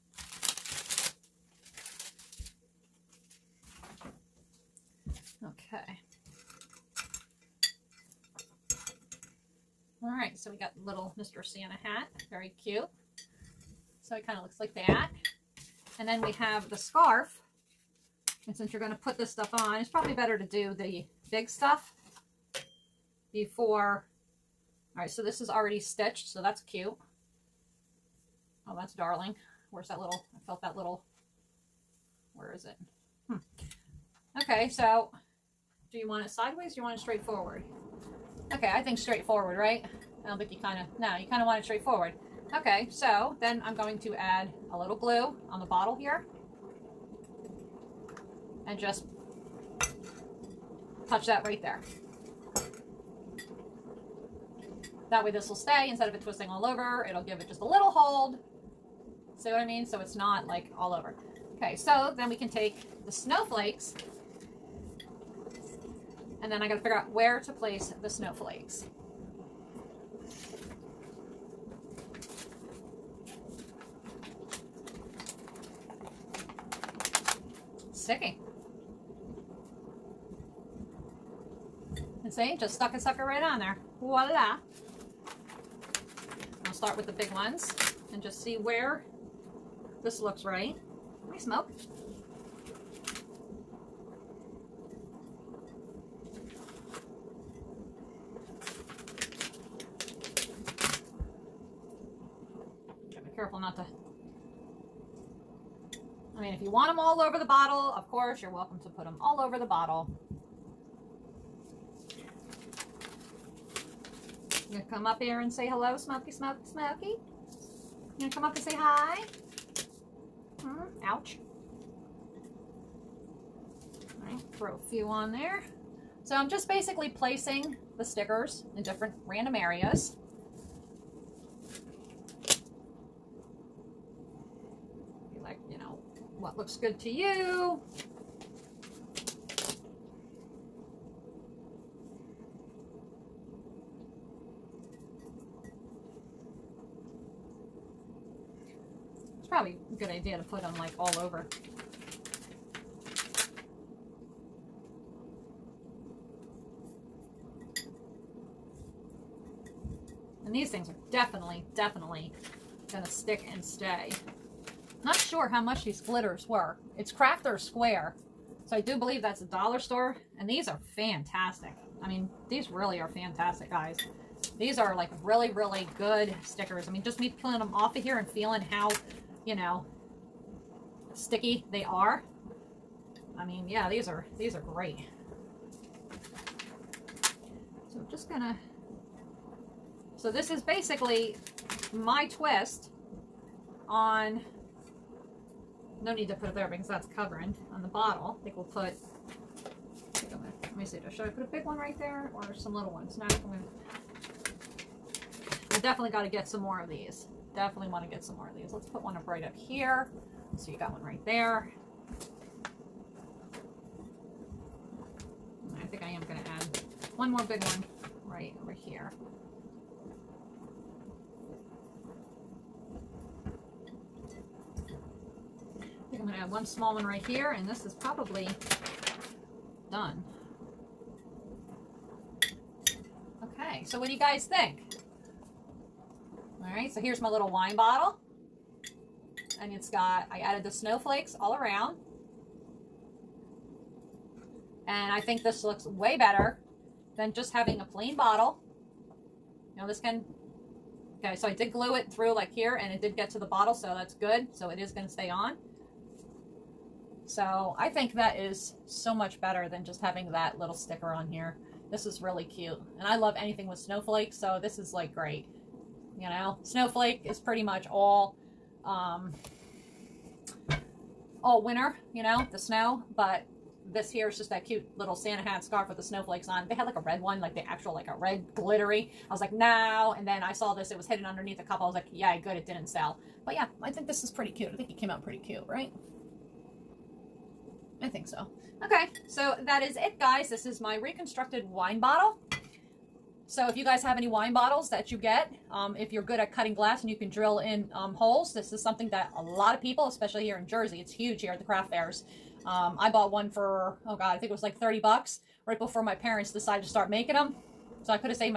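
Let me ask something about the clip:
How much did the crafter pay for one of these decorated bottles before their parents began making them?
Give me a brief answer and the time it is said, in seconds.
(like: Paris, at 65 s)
$30, at 304 s.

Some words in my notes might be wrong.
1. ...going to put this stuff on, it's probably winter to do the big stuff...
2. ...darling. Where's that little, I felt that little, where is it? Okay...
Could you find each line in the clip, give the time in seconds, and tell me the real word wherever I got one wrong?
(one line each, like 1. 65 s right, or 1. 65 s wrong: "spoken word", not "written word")
1. 18 s wrong: "better", not "winter"
2. 28 s right.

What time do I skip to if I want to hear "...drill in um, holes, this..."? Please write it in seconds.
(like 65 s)
297 s.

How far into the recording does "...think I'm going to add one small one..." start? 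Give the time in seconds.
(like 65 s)
226 s.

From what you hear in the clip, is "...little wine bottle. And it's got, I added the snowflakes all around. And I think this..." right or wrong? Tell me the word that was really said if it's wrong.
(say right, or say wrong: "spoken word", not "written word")
right.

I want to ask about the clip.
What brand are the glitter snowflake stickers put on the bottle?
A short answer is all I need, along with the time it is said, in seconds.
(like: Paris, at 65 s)
Crafter's Square, at 167 s.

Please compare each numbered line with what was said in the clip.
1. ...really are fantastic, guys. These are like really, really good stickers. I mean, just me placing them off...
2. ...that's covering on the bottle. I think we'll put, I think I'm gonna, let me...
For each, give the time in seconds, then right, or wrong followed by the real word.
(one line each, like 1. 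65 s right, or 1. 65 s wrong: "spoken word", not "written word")
1. 172 s wrong: "peeling", not "placing"
2. 196 s right.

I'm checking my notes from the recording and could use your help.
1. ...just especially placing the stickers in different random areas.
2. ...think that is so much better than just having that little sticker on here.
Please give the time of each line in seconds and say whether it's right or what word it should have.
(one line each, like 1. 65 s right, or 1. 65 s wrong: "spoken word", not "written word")
1. 126 s wrong: "basically", not "especially"
2. 257 s right.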